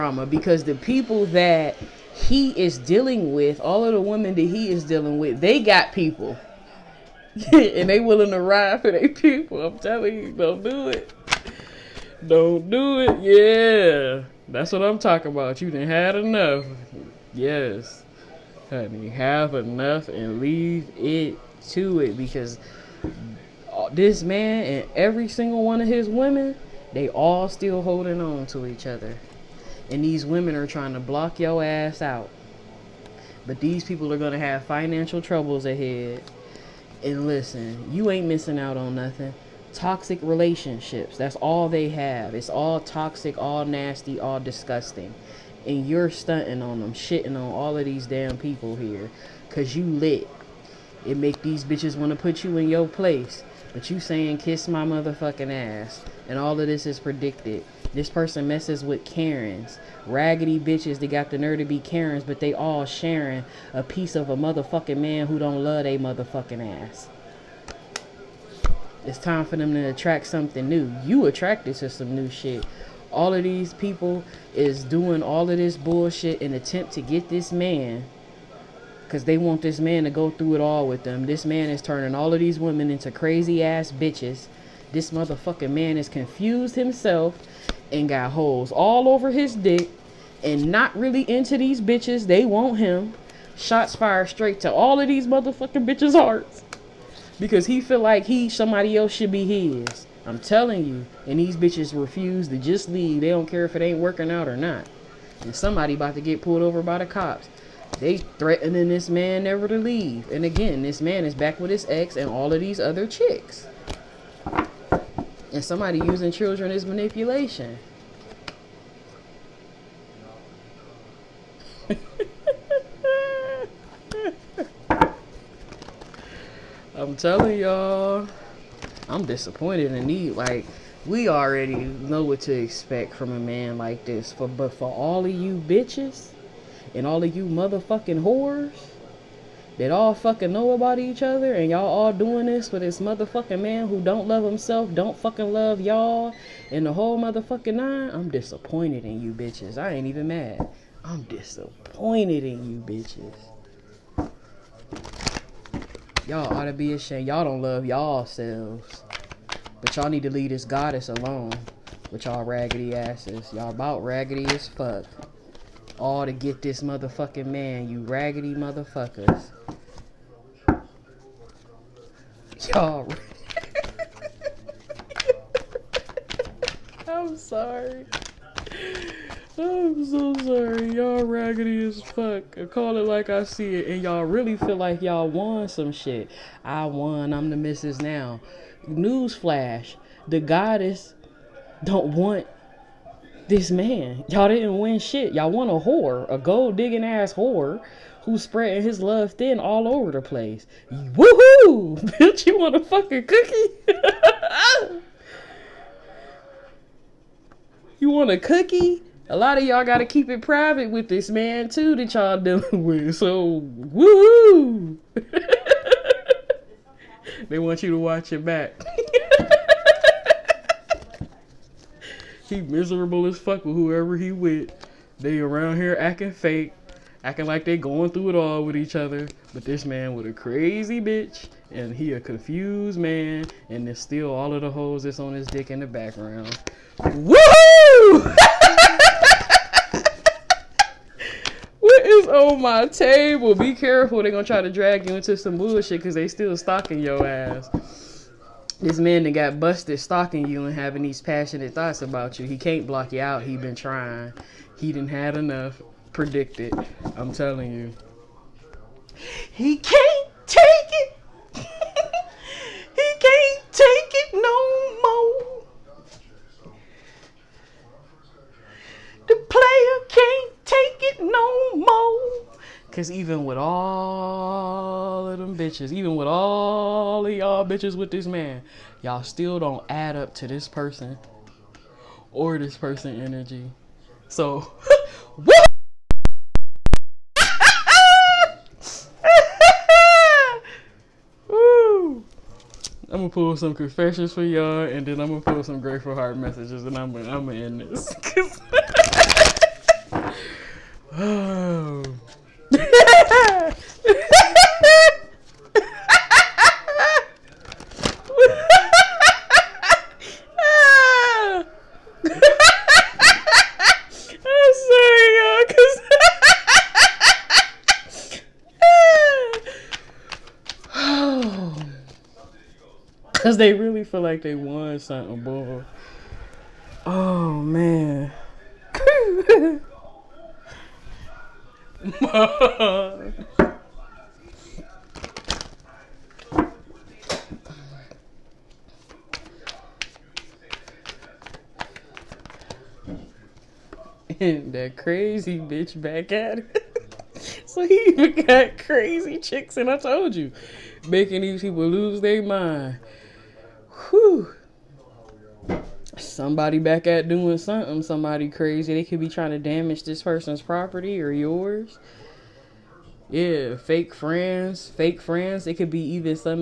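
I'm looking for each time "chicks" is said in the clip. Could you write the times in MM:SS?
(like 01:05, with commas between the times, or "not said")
01:53, 05:49.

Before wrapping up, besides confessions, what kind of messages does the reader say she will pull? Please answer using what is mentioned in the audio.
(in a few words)
grateful heart messages.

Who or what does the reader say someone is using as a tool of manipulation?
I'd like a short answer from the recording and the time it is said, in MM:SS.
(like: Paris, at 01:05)
children, at 01:56.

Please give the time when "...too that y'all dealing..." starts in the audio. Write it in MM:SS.
03:31.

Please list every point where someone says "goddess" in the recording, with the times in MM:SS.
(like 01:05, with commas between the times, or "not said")
02:40, 03:10.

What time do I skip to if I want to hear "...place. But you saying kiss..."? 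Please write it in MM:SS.
00:52.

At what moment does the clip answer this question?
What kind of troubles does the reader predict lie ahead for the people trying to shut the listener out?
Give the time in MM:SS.
00:34.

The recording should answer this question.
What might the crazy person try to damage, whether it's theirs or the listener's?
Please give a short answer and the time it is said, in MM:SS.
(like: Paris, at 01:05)
property, at 06:00.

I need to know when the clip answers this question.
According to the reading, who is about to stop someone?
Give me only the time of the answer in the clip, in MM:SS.
01:46.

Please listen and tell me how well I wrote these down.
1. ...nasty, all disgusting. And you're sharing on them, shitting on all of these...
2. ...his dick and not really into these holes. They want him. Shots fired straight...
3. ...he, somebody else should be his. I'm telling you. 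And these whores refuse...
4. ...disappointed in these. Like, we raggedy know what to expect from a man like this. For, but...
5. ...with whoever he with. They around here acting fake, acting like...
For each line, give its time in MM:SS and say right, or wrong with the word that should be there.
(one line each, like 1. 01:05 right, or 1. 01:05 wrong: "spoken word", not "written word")
1. 00:43 wrong: "stunting", not "sharing"
2. 01:29 wrong: "bitches", not "holes"
3. 01:38 wrong: "bitches", not "whores"
4. 02:09 wrong: "already", not "raggedy"
5. 03:43 right.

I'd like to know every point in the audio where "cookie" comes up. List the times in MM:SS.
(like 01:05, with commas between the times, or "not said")
03:23, 03:28.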